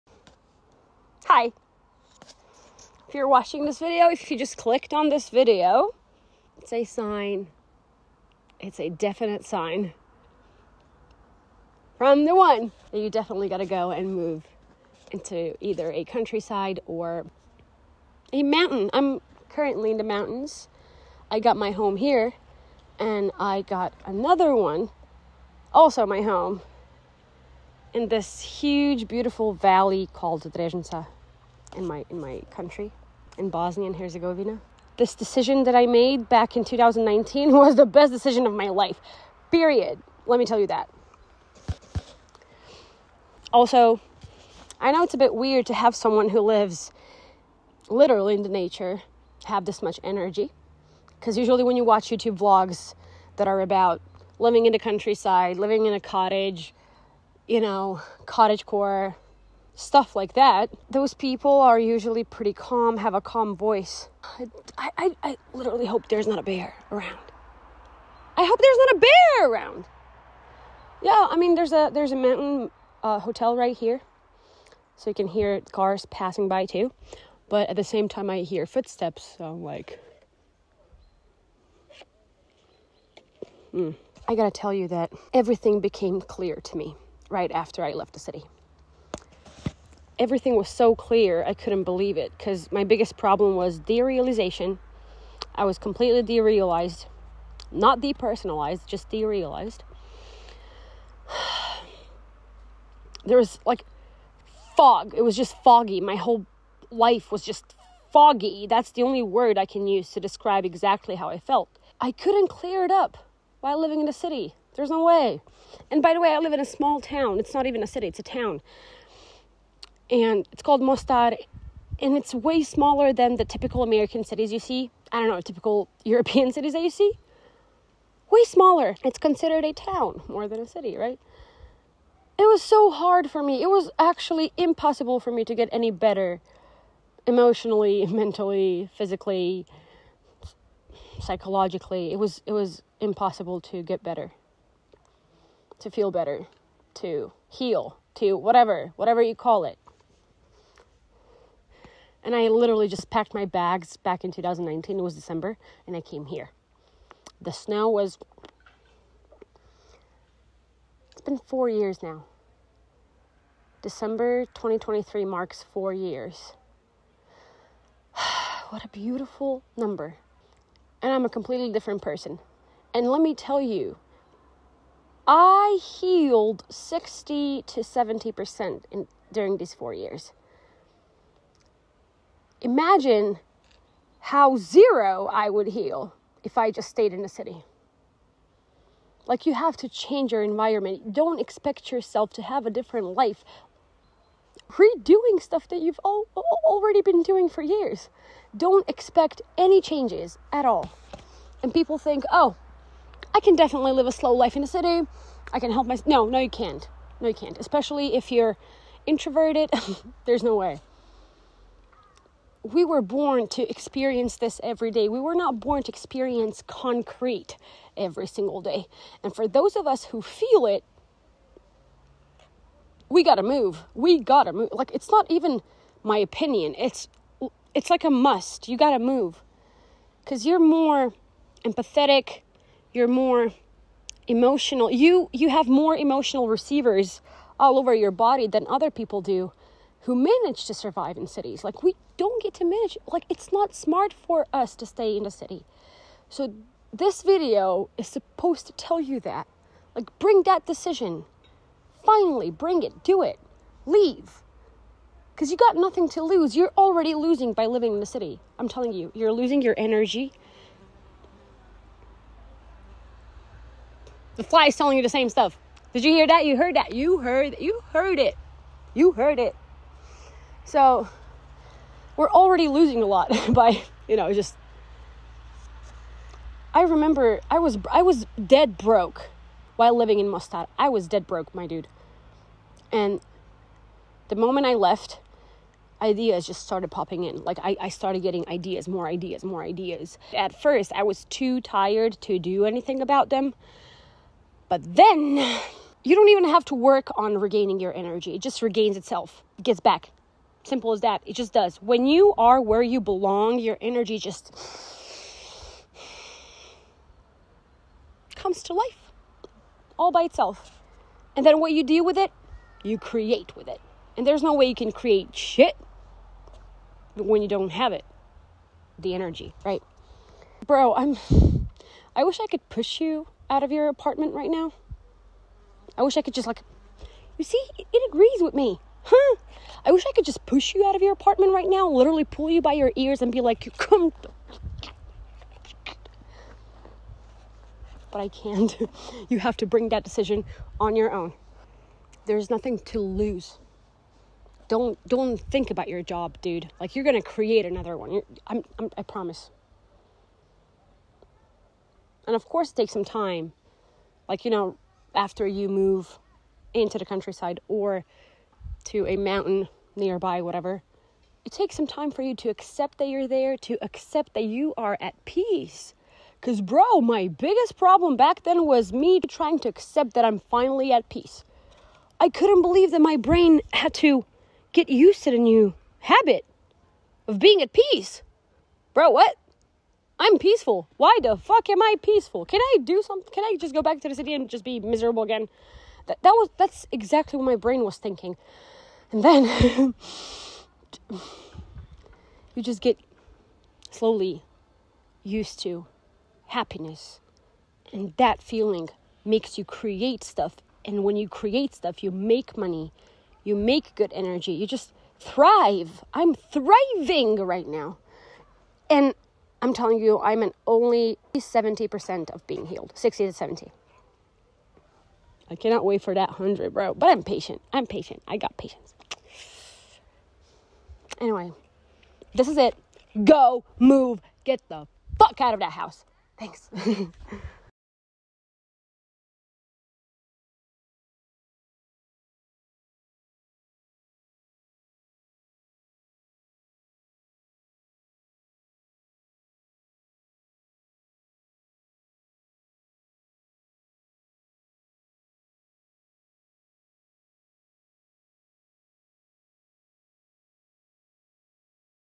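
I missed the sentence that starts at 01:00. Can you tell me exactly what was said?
Those people are usually pretty calm, have a calm voice.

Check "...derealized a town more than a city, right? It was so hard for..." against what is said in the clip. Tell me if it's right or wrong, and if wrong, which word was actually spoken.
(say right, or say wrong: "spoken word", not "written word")
wrong: "considered", not "derealized".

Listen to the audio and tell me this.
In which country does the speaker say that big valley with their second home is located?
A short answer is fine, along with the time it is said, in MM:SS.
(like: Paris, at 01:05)
Bosnia and Herzegovina, at 00:33.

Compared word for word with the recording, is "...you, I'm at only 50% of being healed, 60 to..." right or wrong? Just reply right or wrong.
wrong.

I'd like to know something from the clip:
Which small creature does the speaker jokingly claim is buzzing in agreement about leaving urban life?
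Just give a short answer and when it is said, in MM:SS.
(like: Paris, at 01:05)
fly, at 04:24.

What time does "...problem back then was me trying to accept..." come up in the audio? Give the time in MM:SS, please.
06:07.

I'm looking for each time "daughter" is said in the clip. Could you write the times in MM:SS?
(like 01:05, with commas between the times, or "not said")
not said.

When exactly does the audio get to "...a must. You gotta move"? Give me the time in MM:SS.
03:48.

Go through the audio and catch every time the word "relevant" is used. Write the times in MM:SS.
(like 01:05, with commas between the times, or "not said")
not said.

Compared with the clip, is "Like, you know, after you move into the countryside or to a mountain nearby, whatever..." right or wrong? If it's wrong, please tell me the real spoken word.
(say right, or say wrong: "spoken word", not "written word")
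right.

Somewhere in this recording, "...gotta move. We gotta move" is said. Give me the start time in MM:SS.
03:43.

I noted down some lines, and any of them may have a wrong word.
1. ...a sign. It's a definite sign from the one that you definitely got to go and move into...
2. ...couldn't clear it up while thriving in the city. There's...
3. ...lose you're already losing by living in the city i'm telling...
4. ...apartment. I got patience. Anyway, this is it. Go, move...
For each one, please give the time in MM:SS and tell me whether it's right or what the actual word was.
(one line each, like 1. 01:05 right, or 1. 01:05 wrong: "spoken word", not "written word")
1. 00:06 right
2. 01:52 wrong: "living", not "thriving"
3. 04:16 right
4. 06:57 wrong: "patient", not "apartment".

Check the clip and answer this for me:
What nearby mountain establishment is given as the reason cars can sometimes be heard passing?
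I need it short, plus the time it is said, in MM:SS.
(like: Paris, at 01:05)
hotel, at 01:13.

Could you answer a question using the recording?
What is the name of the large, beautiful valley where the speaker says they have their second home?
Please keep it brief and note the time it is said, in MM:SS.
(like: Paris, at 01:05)
Drežnica, at 00:30.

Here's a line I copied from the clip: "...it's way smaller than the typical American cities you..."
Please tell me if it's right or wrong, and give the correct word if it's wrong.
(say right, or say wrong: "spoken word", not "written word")
right.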